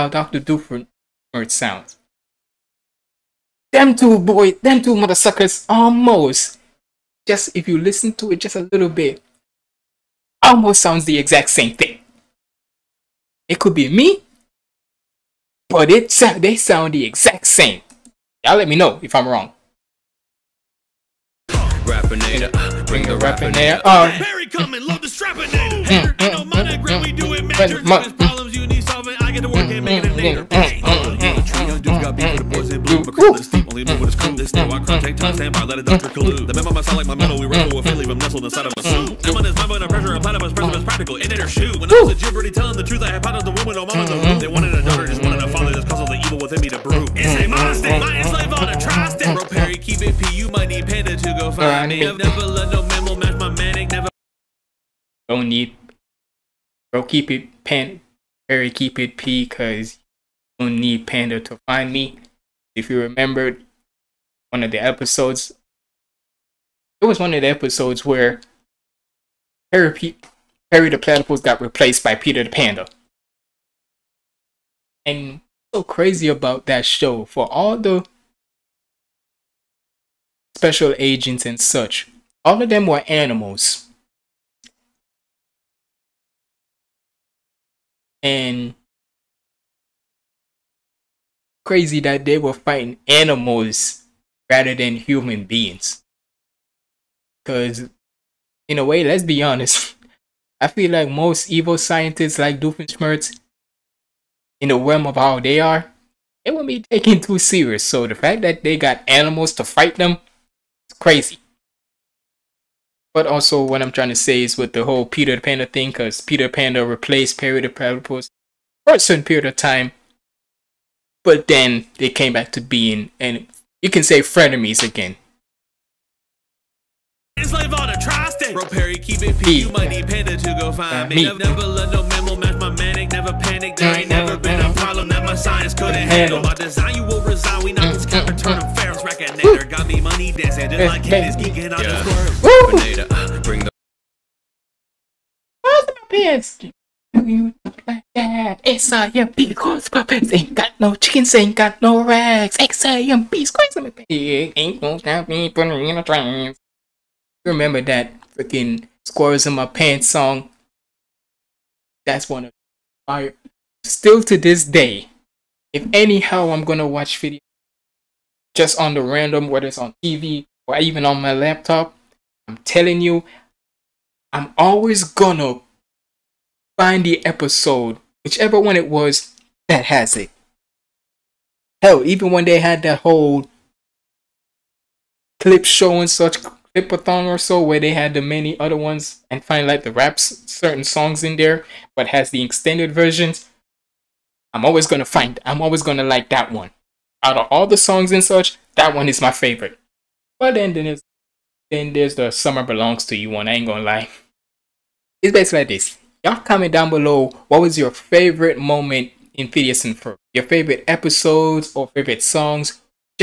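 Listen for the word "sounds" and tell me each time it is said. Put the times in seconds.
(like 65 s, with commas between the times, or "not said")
1 s, 10 s, 16 s.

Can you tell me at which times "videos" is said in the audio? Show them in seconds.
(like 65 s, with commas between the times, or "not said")
167 s.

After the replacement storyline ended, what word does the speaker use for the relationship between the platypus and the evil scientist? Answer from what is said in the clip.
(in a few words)
frenemies.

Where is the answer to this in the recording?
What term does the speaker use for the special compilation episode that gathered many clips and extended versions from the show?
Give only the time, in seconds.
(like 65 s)
186 s.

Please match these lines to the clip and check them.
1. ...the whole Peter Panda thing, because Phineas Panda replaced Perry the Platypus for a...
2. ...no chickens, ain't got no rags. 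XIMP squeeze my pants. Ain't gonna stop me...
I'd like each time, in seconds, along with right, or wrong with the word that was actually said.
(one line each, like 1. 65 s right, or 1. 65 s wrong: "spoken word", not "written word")
1. 114 s wrong: "Peter", not "Phineas"
2. 150 s right.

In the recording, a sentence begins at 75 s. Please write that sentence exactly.
And so crazy about that show, for all the special agents and such, all of them were animals.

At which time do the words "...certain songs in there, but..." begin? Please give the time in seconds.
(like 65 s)
190 s.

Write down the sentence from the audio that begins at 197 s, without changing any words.
Out of all the songs and such, that one is my favorite.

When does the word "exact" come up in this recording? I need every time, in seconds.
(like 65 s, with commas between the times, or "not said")
11 s, 17 s.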